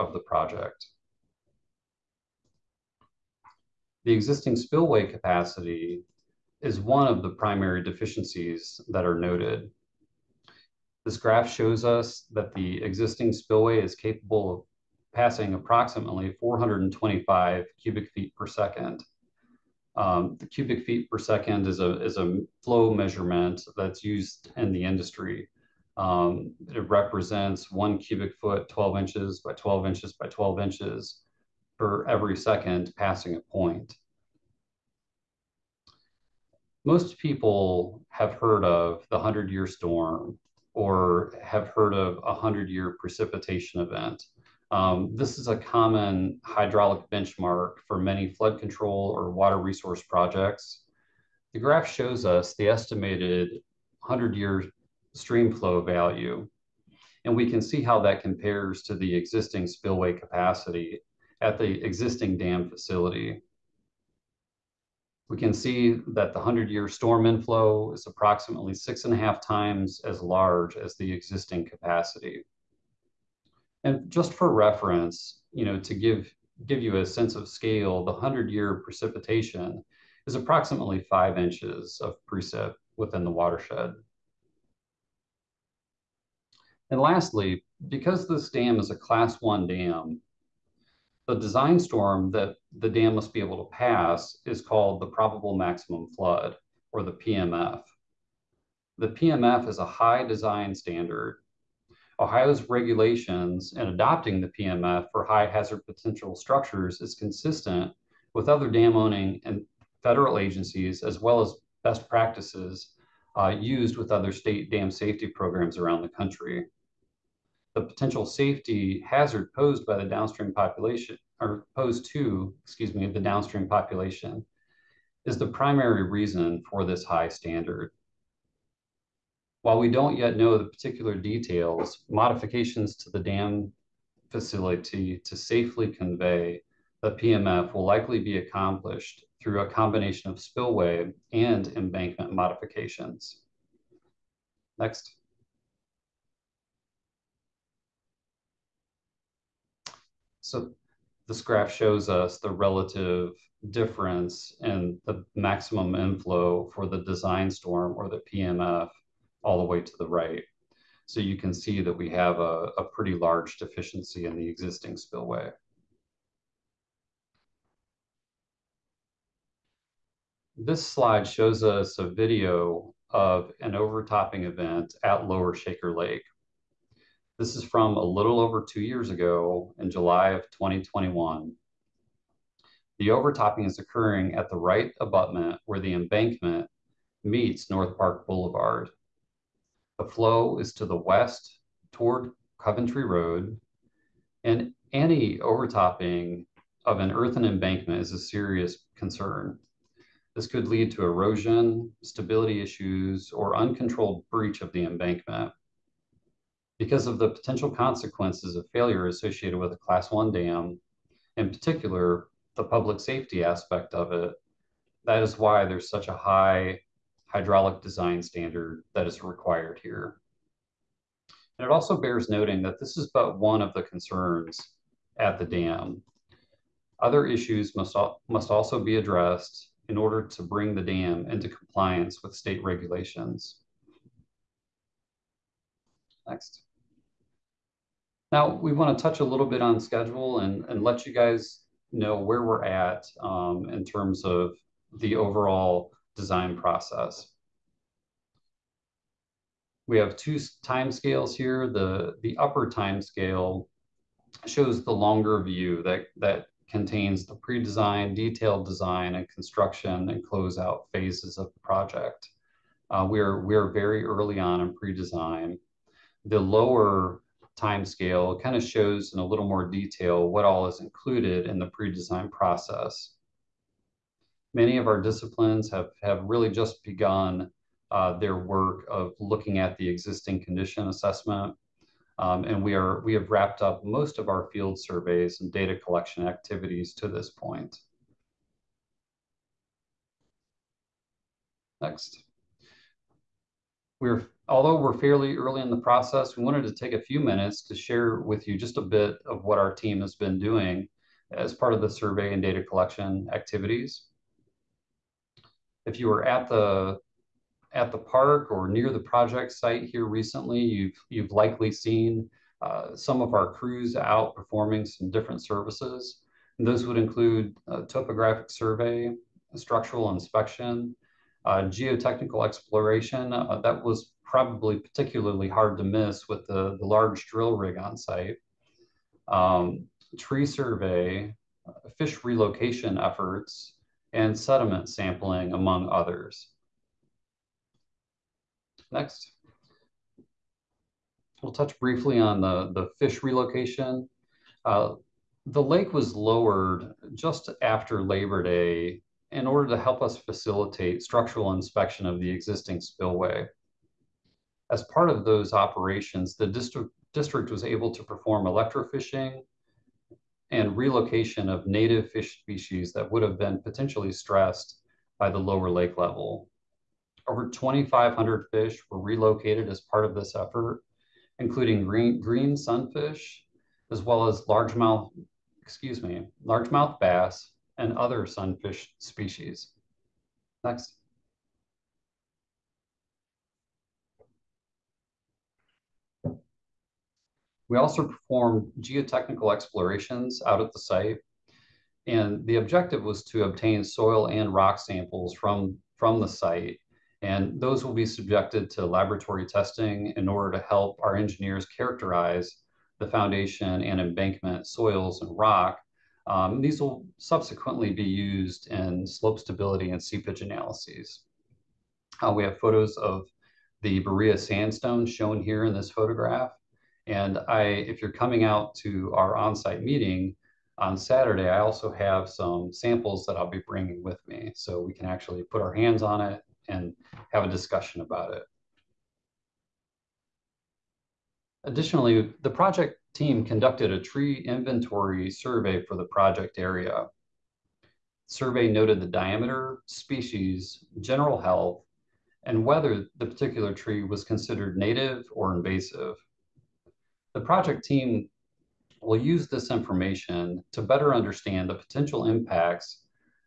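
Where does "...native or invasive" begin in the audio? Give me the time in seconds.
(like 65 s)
444 s.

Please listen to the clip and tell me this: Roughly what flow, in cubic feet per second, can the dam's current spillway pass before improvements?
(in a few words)
425.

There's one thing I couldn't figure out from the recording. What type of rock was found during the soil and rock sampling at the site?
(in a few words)
Berea sandstone.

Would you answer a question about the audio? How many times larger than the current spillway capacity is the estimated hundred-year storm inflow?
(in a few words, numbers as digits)
six and a half.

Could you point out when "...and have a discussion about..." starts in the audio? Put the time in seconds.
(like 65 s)
426 s.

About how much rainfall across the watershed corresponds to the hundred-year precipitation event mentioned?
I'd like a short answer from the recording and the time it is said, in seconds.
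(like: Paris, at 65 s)
5 inches, at 81 s.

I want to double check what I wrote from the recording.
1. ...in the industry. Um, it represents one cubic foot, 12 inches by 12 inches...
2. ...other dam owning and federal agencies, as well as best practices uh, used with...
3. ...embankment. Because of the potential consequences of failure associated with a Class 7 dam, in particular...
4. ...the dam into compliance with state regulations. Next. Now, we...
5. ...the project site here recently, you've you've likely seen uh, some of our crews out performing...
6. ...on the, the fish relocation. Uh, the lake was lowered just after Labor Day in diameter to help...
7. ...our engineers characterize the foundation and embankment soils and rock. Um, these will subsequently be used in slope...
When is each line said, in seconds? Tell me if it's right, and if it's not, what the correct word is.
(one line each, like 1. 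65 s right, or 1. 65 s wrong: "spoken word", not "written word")
1. 24 s right
2. 108 s right
3. 204 s wrong: "1", not "7"
4. 230 s right
5. 308 s right
6. 342 s wrong: "order", not "diameter"
7. 401 s right.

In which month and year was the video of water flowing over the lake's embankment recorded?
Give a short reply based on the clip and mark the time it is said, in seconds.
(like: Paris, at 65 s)
July 2021, at 179 s.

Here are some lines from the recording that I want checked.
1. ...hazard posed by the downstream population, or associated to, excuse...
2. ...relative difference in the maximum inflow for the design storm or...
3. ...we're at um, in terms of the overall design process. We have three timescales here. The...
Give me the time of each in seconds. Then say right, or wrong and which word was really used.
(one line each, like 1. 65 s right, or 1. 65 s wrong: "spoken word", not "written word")
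1. 119 s wrong: "posed", not "associated"
2. 152 s right
3. 242 s wrong: "two", not "three".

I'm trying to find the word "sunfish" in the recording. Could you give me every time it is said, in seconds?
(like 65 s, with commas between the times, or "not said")
372 s, 378 s.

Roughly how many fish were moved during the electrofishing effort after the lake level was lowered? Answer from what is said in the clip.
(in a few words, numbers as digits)
2,500.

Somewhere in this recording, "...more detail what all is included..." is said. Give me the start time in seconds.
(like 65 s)
269 s.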